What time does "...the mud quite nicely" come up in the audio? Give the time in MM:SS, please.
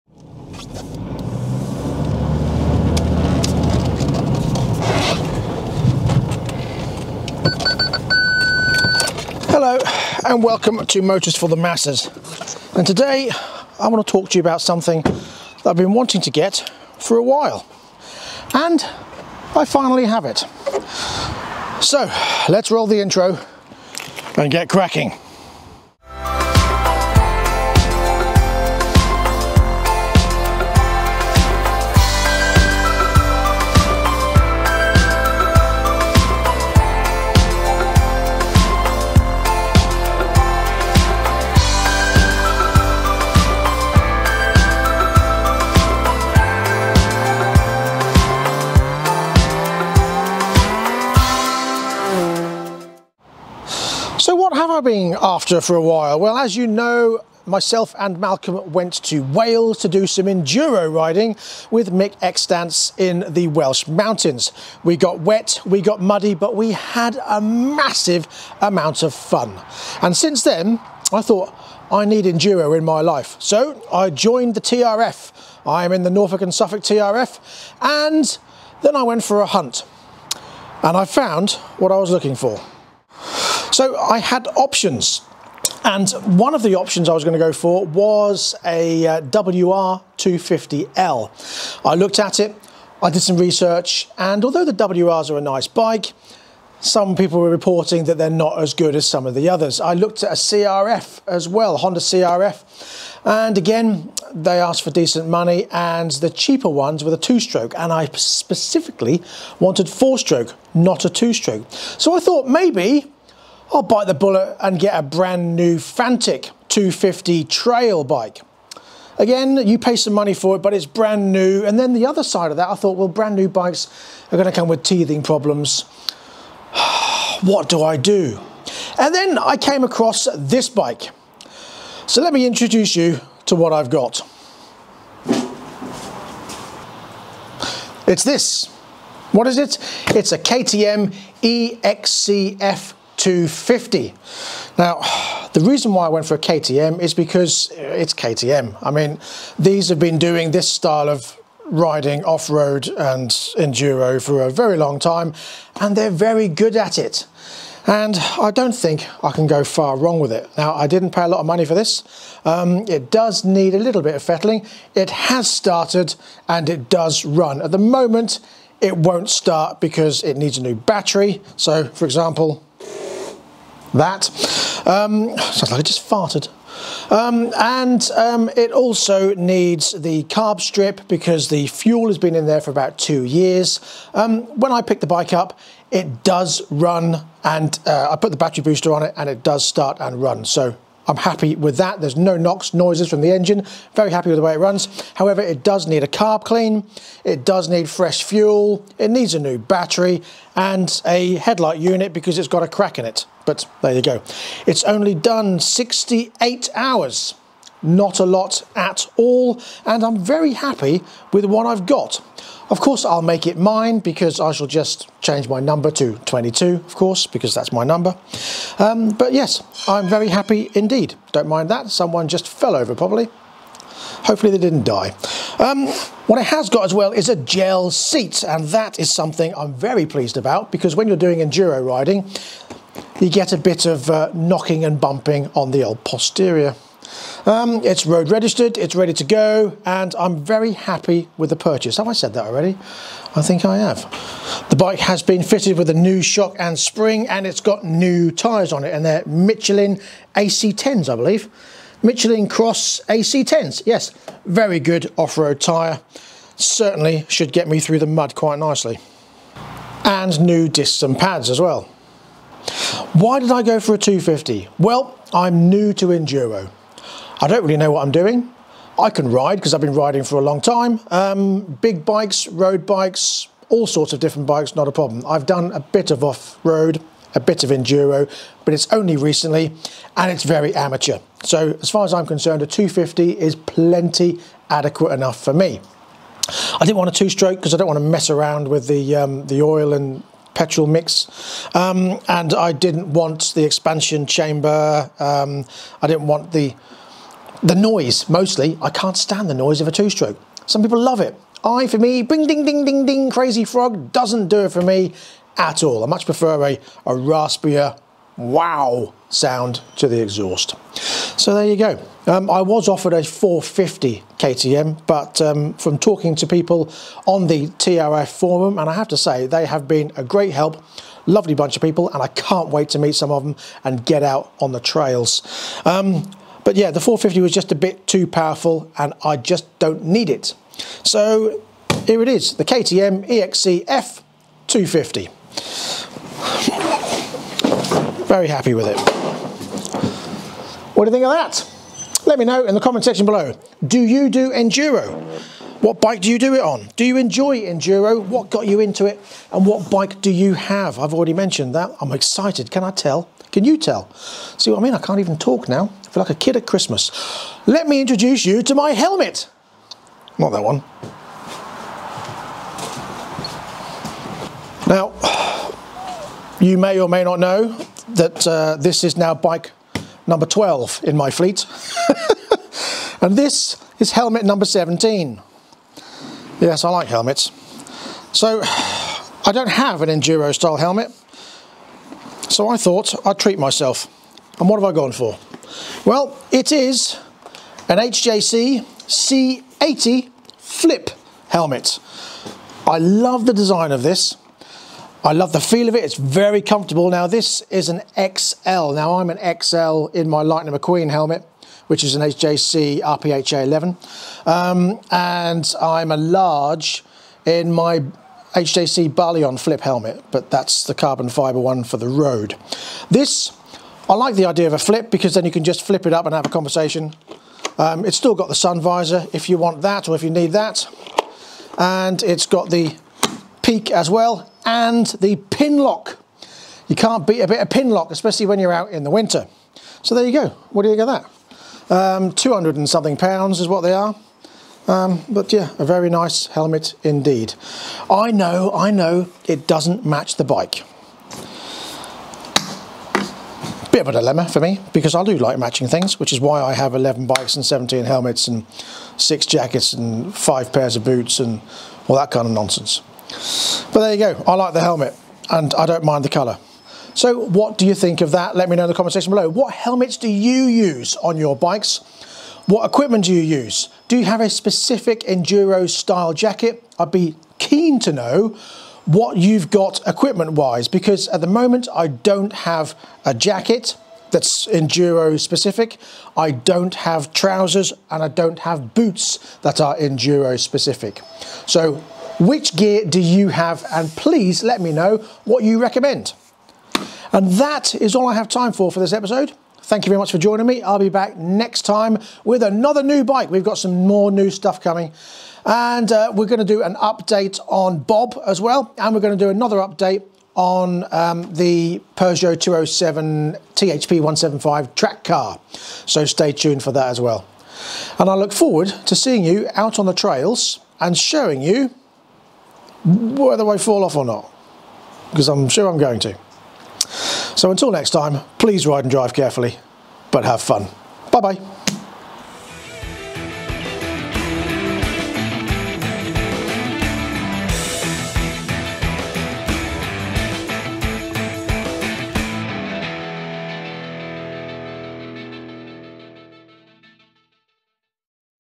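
04:17.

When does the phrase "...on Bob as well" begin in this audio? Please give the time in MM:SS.
08:17.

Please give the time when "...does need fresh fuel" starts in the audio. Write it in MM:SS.
03:17.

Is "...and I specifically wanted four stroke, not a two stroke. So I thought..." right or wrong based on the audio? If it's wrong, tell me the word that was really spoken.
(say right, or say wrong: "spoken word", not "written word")
right.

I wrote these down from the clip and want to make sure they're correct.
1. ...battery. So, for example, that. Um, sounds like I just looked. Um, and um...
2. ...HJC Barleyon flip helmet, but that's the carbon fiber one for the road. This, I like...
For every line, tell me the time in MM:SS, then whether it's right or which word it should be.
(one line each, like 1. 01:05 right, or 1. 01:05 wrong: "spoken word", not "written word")
1. 02:50 wrong: "farted", not "looked"
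2. 06:48 right.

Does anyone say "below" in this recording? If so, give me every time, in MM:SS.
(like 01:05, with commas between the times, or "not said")
05:43, 07:39.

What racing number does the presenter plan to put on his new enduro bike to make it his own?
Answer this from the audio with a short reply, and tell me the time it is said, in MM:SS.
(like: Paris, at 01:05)
22, at 03:36.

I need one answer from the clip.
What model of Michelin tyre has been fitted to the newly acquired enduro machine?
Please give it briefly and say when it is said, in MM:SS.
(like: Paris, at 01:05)
Cross AC10, at 04:12.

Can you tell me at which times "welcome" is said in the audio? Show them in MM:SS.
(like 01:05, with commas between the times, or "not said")
00:10.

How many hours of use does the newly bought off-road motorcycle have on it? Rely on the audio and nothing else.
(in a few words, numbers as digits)
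68 hours.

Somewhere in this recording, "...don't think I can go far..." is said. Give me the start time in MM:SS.
02:38.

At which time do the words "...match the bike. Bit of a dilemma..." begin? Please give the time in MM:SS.
07:20.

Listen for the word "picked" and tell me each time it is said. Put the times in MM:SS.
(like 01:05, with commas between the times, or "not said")
03:04.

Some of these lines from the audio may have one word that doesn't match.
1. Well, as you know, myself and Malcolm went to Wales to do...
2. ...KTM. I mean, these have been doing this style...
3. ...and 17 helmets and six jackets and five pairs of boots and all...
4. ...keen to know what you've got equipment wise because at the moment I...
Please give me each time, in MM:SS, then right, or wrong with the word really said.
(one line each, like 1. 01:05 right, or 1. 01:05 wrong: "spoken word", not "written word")
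1. 00:56 right
2. 02:28 right
3. 07:27 right
4. 07:47 right.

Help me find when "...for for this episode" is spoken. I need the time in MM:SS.
08:08.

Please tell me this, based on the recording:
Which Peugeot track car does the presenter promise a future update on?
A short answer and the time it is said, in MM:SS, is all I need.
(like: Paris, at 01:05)
207 THP 175, at 08:22.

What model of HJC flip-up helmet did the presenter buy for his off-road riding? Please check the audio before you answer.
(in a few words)
C80.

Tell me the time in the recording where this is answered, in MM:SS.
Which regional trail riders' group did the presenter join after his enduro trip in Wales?
01:16.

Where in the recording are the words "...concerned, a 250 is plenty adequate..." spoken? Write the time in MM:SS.
04:42.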